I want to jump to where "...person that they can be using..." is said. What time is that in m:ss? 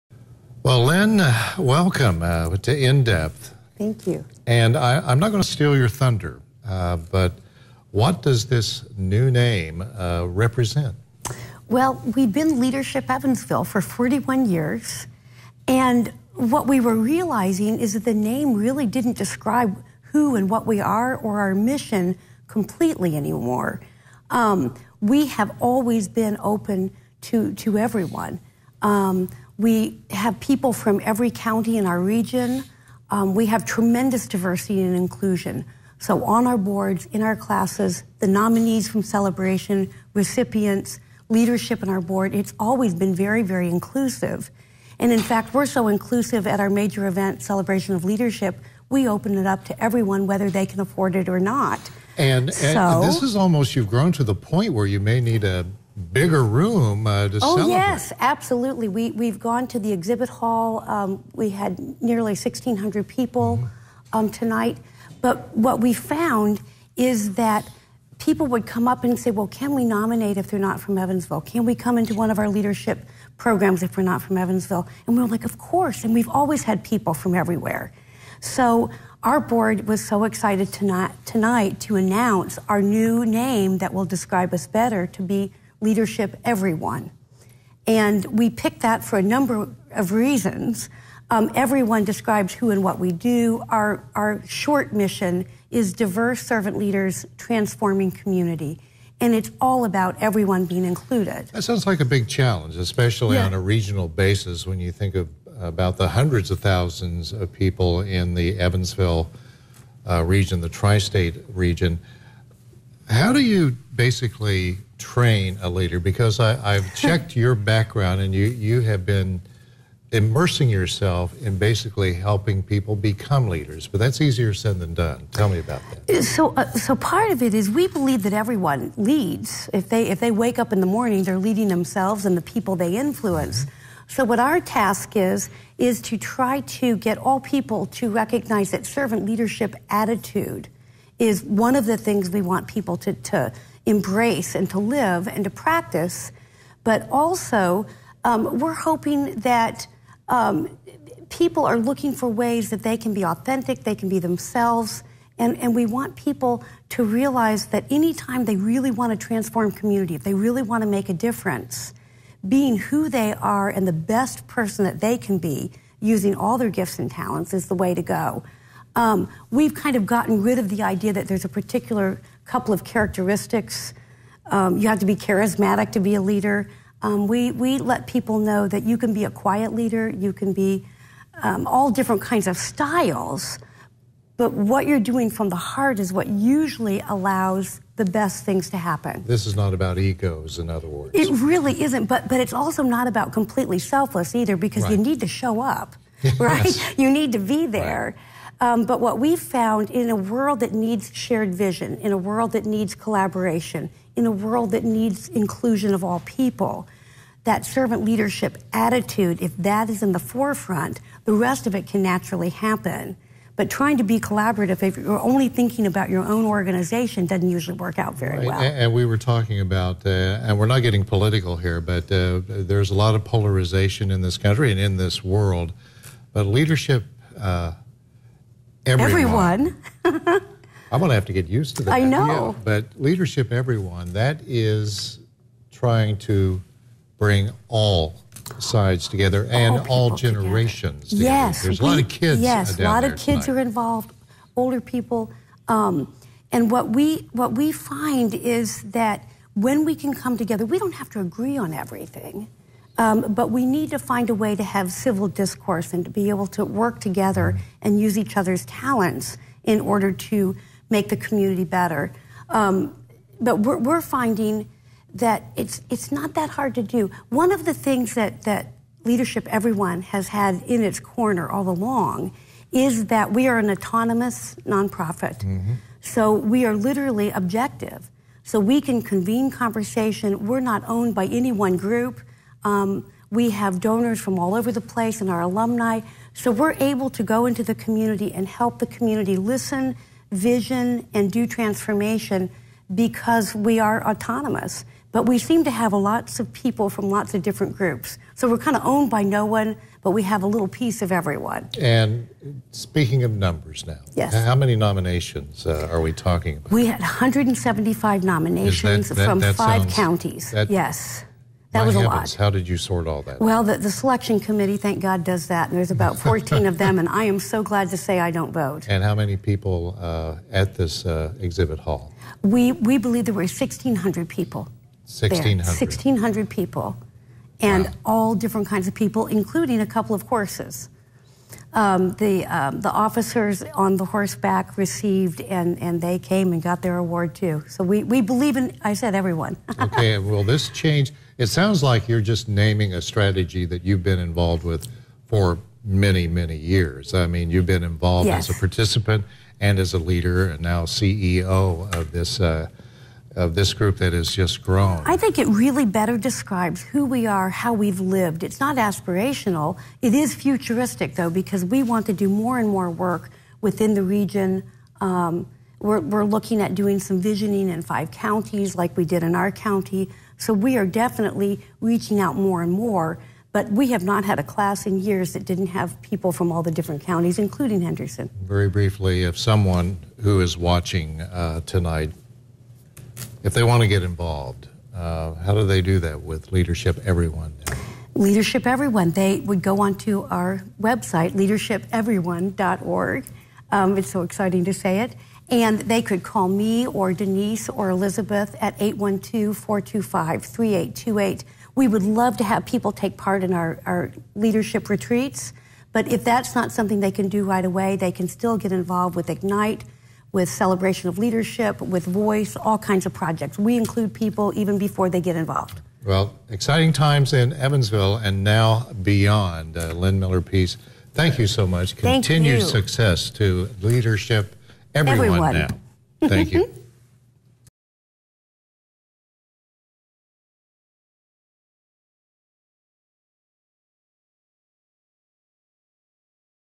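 2:44.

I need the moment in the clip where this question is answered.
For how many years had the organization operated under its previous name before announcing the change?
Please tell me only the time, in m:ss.
0:13.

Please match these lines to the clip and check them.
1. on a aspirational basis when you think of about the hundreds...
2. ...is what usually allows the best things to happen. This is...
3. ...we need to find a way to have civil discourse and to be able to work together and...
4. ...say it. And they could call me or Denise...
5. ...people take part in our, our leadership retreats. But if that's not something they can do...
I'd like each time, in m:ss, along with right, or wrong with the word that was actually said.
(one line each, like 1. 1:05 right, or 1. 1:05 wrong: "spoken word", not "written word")
1. 1:43 wrong: "regional", not "aspirational"
2. 3:05 right
3. 4:13 right
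4. 6:34 right
5. 6:42 right.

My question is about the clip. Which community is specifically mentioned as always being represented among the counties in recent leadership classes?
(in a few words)
Henderson.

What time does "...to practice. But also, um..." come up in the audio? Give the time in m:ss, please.
2:25.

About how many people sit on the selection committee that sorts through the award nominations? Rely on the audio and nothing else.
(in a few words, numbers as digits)
14.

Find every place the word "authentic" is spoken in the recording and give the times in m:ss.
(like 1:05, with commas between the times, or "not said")
2:33.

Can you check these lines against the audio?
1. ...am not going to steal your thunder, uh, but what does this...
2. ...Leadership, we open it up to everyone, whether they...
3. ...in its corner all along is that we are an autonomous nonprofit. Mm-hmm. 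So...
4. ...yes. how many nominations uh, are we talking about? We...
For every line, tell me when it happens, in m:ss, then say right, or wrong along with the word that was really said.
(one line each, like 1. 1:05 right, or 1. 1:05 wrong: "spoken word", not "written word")
1. 0:05 right
2. 0:48 right
3. 4:30 right
4. 5:04 right.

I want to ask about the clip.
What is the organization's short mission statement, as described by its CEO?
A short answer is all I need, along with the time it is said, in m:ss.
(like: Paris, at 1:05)
Diverse servant leaders transforming community, at 1:35.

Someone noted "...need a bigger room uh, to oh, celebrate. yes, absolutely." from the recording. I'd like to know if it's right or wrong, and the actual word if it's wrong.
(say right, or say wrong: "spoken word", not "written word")
right.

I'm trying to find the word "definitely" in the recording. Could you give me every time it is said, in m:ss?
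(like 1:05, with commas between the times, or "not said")
6:10.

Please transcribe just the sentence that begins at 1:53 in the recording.
How do you basically train a leader?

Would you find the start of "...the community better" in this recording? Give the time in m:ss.
4:21.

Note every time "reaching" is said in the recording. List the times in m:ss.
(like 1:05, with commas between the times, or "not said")
6:11.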